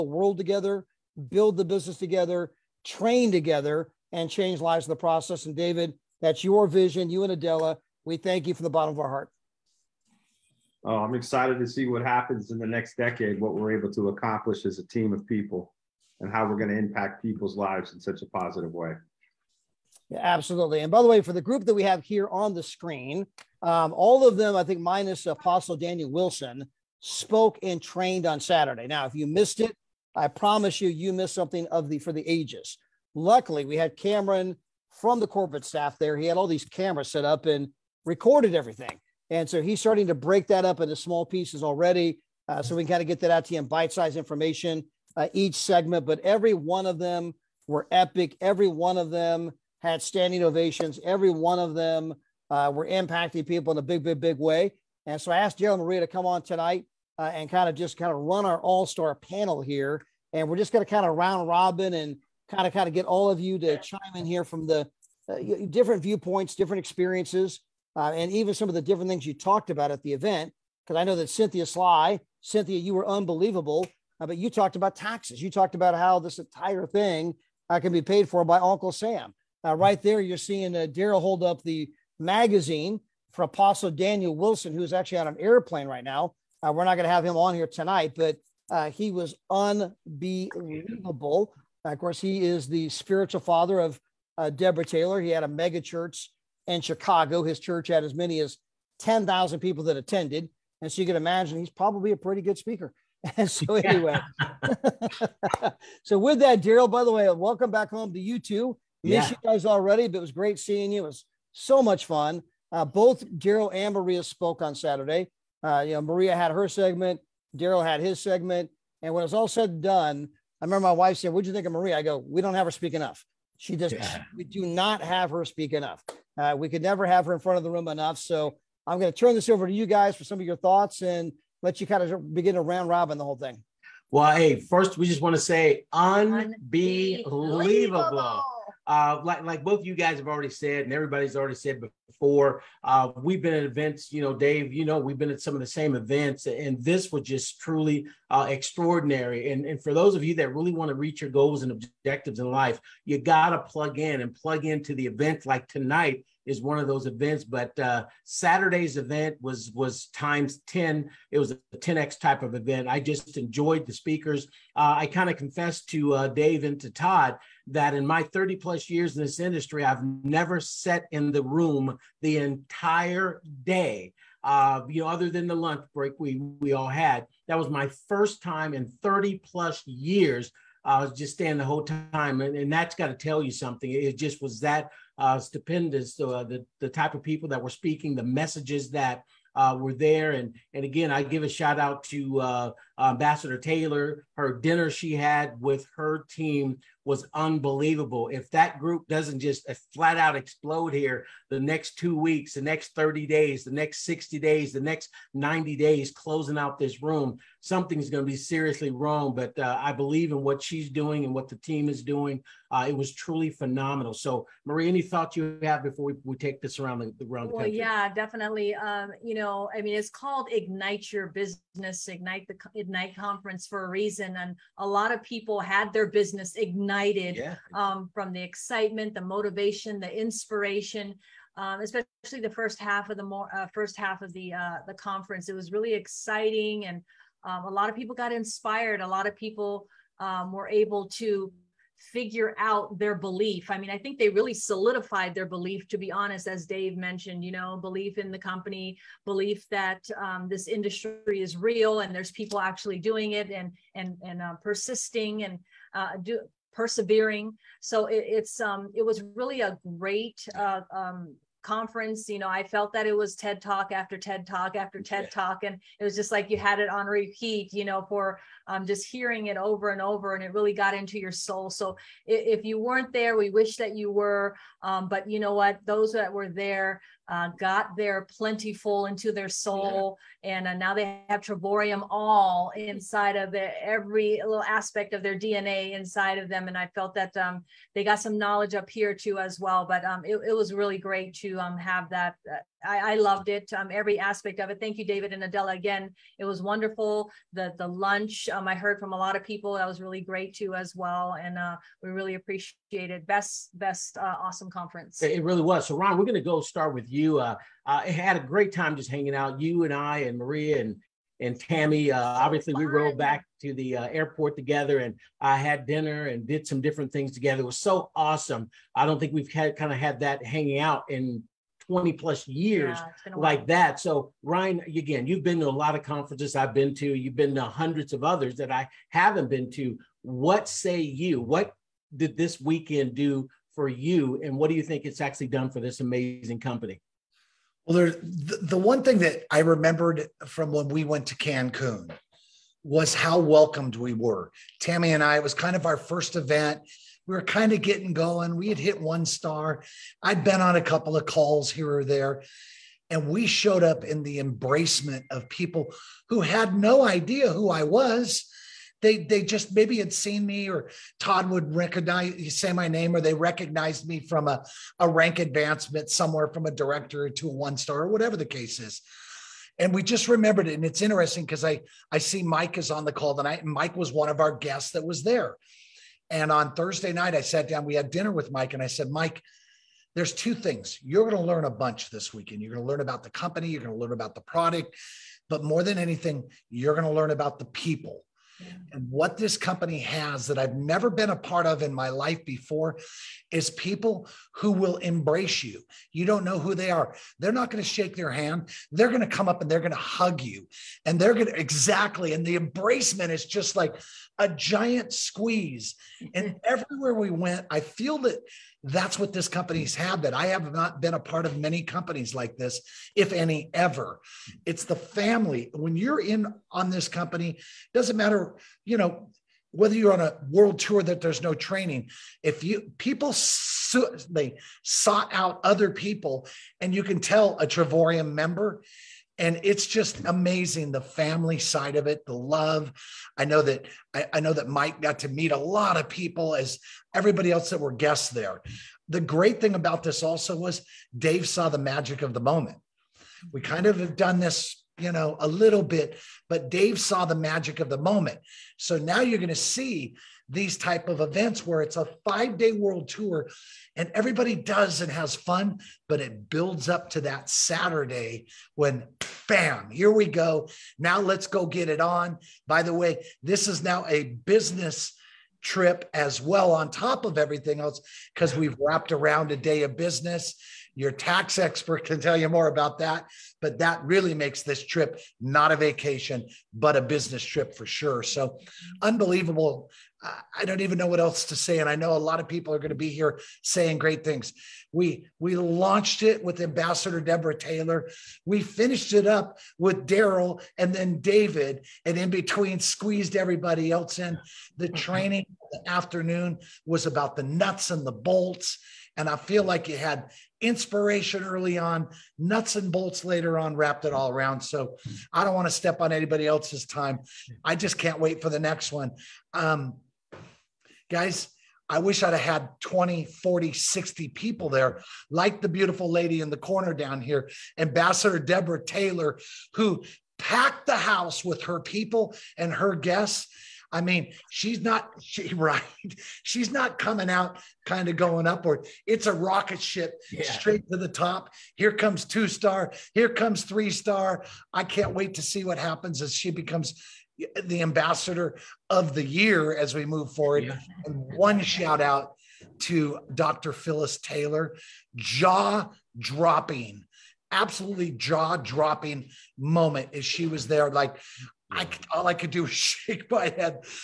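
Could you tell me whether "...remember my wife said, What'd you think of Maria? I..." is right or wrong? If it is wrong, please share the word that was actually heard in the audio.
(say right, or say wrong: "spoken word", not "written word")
right.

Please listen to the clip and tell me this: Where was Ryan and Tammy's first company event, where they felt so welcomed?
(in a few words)
Cancun.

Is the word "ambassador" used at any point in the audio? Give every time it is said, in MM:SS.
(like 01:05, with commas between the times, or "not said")
03:13, 08:06, 08:37, 08:57.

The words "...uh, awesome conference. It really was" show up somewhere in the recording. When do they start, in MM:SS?
05:04.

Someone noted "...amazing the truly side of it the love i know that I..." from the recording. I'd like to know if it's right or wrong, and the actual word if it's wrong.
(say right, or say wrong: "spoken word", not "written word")
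wrong: "family", not "truly".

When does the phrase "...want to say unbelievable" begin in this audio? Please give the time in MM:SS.
02:15.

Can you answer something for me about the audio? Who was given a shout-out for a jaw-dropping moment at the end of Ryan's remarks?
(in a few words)
Dr. Phyllis Taylor.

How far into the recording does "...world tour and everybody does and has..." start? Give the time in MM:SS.
07:32.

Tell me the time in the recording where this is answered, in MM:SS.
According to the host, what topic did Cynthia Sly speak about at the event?
01:14.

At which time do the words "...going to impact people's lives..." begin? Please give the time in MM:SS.
00:16.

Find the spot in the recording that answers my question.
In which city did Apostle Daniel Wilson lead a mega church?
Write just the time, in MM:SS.
01:36.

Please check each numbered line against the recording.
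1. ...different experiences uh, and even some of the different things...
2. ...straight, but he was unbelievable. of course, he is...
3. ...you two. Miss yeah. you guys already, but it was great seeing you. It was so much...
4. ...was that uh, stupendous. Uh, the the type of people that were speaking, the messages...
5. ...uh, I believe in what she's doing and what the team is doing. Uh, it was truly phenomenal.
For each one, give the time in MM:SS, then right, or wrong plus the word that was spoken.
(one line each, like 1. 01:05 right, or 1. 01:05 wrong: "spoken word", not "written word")
1. 01:06 right
2. 01:27 wrong: "tonight", not "straight"
3. 01:48 right
4. 03:04 right
5. 03:29 right.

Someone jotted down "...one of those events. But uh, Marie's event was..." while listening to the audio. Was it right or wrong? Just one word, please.
wrong.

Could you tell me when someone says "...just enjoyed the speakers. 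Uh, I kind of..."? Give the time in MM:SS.
02:42.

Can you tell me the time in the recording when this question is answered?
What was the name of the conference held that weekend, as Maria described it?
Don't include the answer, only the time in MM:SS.
03:42.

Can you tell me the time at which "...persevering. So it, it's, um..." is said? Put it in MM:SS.
04:16.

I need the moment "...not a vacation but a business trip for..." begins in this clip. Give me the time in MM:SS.
07:55.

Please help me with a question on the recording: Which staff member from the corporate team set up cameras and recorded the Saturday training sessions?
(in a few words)
Cameron.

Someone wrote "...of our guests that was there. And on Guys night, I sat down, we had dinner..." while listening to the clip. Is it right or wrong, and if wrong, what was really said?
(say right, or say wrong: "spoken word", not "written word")
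wrong: "Thursday", not "Guys".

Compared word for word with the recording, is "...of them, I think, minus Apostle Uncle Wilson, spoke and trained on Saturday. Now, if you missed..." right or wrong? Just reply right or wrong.
wrong.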